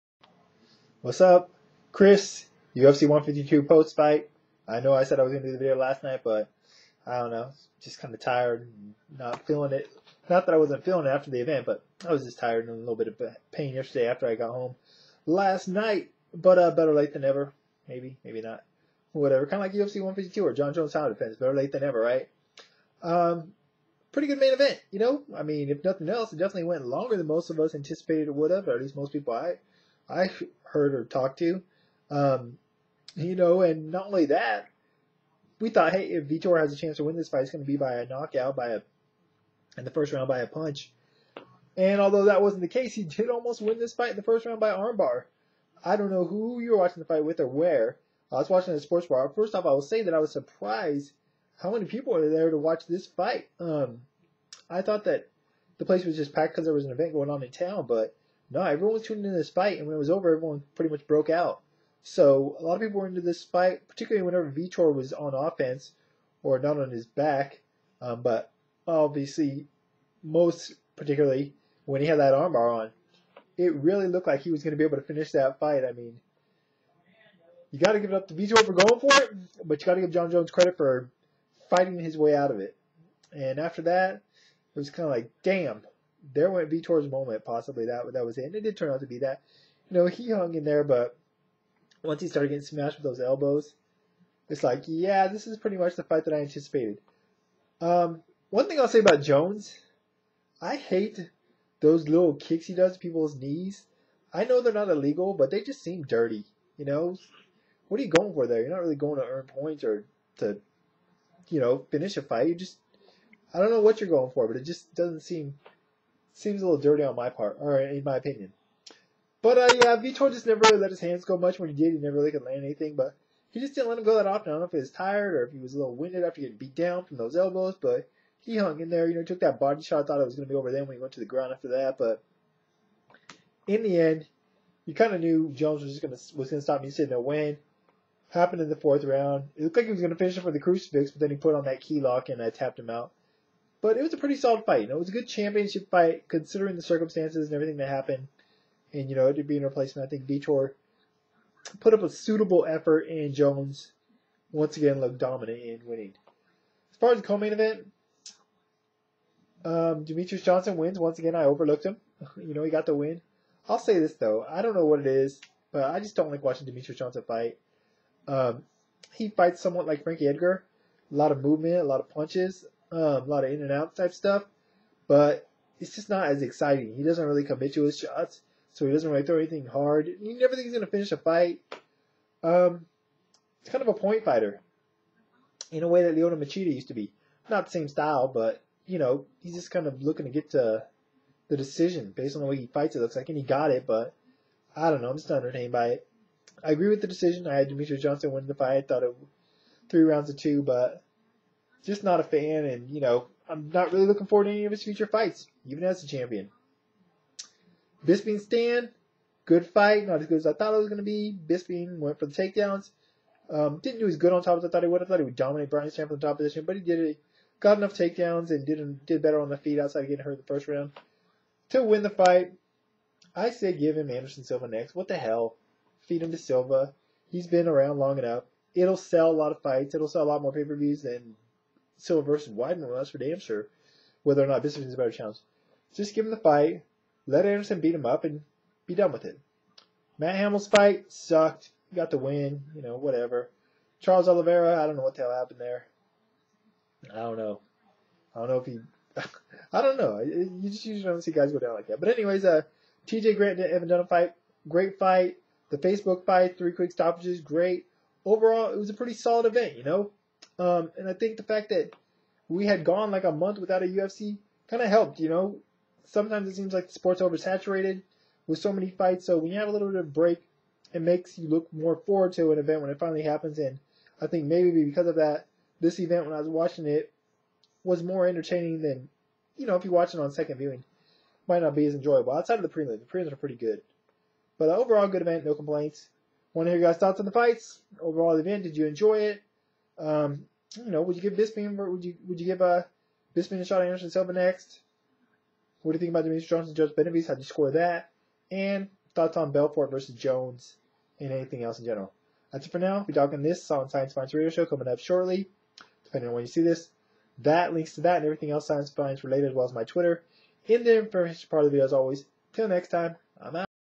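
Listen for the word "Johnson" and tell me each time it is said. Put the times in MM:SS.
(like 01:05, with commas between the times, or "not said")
02:40, 02:46, 03:18, 04:56.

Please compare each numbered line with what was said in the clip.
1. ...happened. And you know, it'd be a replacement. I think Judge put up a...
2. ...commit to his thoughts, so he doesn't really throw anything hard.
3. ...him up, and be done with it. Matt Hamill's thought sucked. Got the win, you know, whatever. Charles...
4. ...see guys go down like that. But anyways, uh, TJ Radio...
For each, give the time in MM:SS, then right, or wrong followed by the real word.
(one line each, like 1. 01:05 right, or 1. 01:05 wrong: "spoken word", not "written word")
1. 02:27 wrong: "Vitor", not "Judge"
2. 02:57 wrong: "shots", not "thoughts"
3. 03:57 wrong: "fight", not "thought"
4. 04:11 wrong: "Grant", not "Radio".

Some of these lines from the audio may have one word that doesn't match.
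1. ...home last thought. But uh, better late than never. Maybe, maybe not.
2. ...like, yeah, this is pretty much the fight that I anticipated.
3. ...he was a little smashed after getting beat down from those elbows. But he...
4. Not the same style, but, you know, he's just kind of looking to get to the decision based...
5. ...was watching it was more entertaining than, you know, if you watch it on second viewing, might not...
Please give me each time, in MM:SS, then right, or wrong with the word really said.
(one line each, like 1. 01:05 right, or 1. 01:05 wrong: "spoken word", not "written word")
1. 00:14 wrong: "night", not "thought"
2. 01:34 right
3. 02:05 wrong: "winded", not "smashed"
4. 03:07 right
5. 04:36 right.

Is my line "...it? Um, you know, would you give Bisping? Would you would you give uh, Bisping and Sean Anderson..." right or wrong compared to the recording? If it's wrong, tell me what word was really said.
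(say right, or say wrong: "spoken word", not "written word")
right.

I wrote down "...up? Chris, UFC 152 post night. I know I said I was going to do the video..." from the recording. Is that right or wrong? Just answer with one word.
wrong.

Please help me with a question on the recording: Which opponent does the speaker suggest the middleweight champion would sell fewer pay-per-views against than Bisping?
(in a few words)
Weidman.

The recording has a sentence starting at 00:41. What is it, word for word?
And although that wasn't the case, he did almost win this fight in the first round by armbar.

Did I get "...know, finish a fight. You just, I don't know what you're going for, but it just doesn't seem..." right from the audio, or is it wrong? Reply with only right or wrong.
right.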